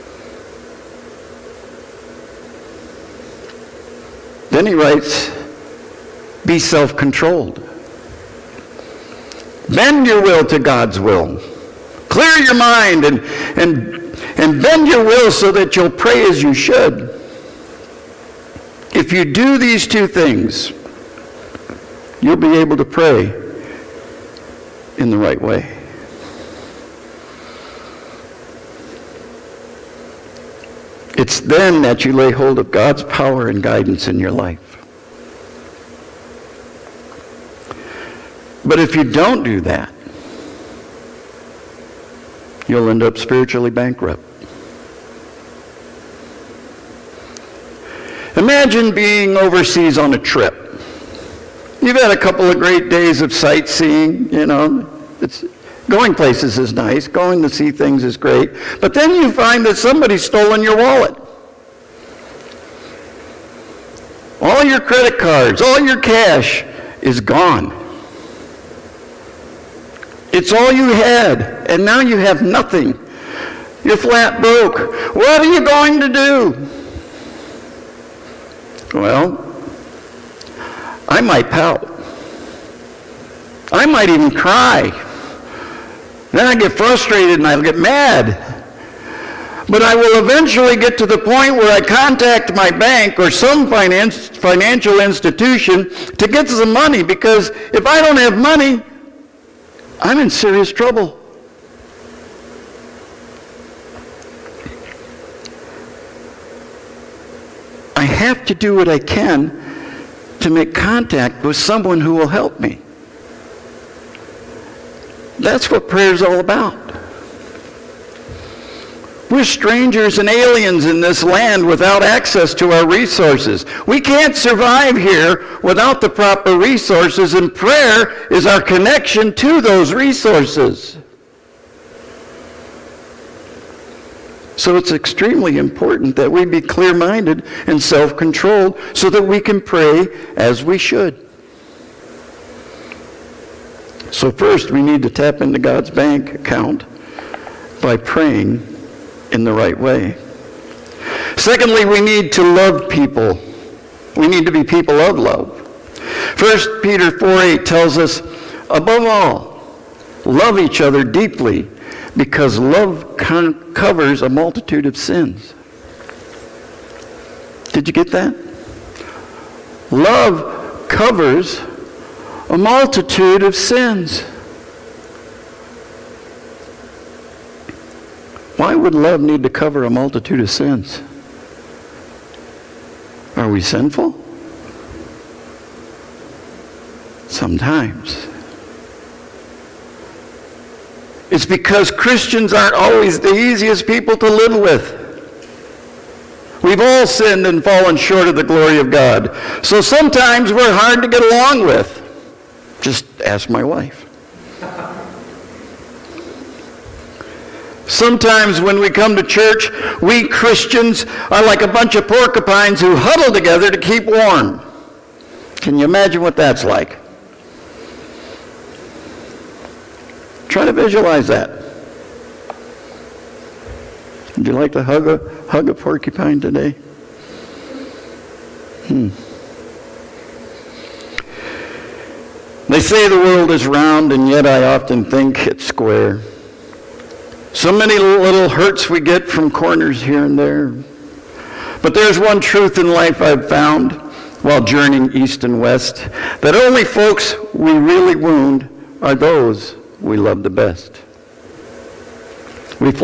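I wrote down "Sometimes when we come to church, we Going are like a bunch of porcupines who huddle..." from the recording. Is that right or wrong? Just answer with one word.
wrong.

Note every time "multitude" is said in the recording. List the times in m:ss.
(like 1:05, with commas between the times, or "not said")
2:44, 2:52, 2:59.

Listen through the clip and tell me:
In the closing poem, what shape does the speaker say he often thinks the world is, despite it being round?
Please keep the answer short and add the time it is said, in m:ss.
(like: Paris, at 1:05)
Square, at 3:55.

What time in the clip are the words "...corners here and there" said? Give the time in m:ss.
3:59.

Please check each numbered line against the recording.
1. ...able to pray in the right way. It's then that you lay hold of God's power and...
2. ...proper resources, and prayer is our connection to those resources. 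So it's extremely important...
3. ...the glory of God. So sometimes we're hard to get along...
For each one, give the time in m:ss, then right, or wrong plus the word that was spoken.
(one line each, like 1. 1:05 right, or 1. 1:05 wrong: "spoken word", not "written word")
1. 0:22 right
2. 2:06 right
3. 3:18 right.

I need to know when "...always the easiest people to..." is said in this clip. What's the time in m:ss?
3:12.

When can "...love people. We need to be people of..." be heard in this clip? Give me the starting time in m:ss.
2:32.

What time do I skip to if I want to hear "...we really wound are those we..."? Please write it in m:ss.
4:07.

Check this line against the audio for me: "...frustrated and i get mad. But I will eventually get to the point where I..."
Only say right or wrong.
right.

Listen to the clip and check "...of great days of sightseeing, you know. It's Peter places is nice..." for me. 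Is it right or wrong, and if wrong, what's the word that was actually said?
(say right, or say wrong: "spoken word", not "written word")
wrong: "Going", not "Peter".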